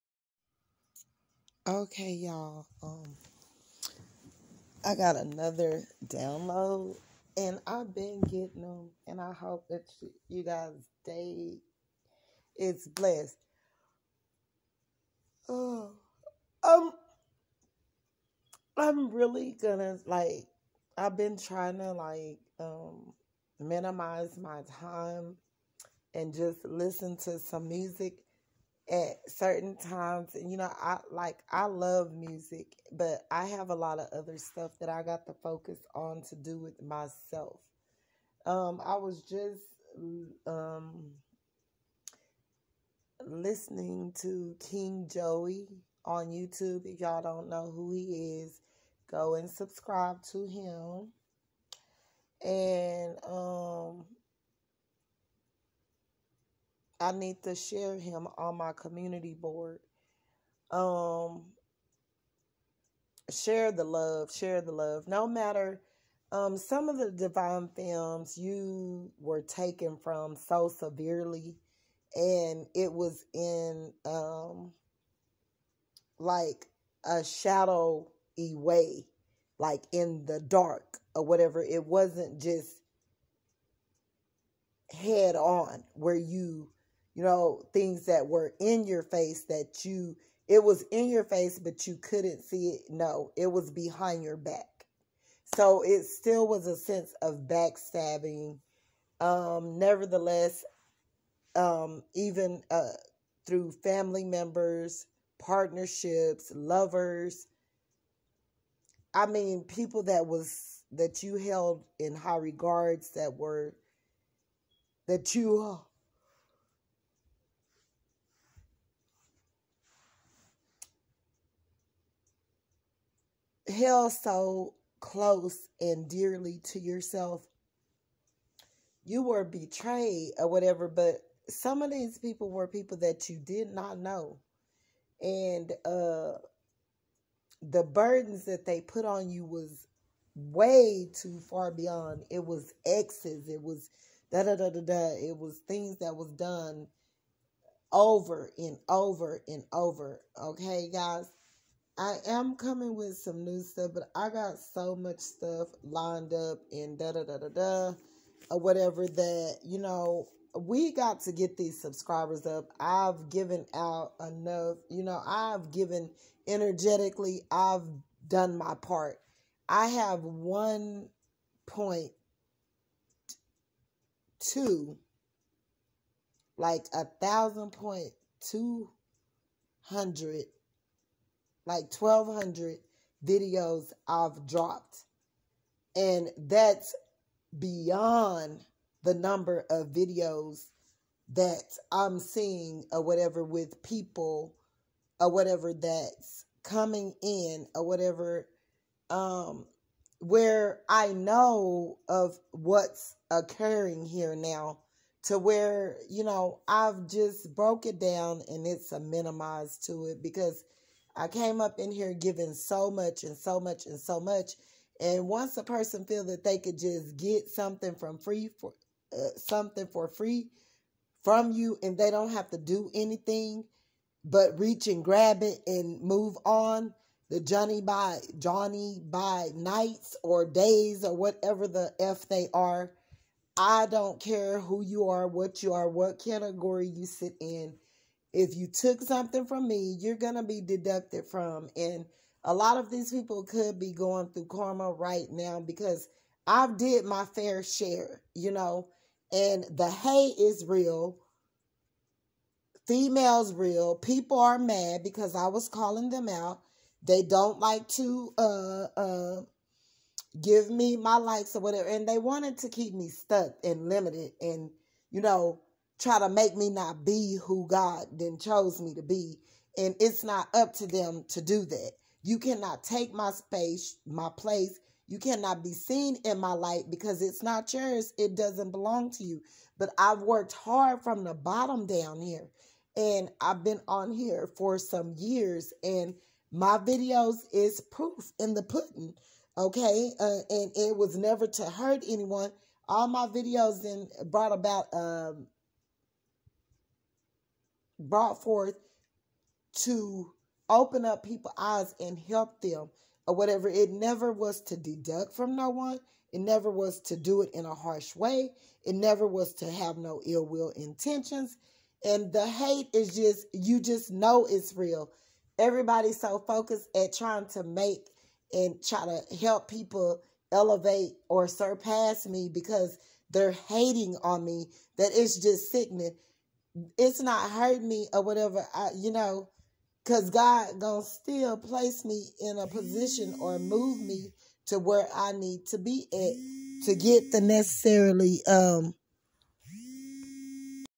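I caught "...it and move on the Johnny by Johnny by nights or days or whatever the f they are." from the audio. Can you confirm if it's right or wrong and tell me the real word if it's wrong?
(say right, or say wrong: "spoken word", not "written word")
right.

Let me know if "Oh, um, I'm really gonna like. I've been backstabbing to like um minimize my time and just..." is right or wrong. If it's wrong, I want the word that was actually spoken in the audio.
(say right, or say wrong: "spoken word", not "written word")
wrong: "trying", not "backstabbing".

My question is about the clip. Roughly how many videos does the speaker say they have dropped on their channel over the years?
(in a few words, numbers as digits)
1,200.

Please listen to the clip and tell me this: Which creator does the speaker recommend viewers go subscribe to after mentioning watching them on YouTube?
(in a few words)
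King Joey.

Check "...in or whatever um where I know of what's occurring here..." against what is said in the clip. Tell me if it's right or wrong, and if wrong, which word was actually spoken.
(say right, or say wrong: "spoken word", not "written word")
right.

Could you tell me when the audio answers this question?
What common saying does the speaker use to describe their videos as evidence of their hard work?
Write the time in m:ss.
4:47.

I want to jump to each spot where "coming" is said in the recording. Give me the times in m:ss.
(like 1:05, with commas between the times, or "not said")
2:32, 3:16.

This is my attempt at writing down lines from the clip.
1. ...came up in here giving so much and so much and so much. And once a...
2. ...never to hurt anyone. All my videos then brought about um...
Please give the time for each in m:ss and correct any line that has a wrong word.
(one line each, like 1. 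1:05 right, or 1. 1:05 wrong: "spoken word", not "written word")
1. 3:31 right
2. 4:51 right.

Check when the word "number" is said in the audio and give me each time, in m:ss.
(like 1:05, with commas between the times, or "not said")
3:09.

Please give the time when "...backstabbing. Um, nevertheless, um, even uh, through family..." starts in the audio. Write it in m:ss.
1:37.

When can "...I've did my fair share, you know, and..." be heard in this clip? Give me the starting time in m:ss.
4:06.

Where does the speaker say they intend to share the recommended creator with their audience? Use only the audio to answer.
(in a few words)
community board.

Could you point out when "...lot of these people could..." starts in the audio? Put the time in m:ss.
4:02.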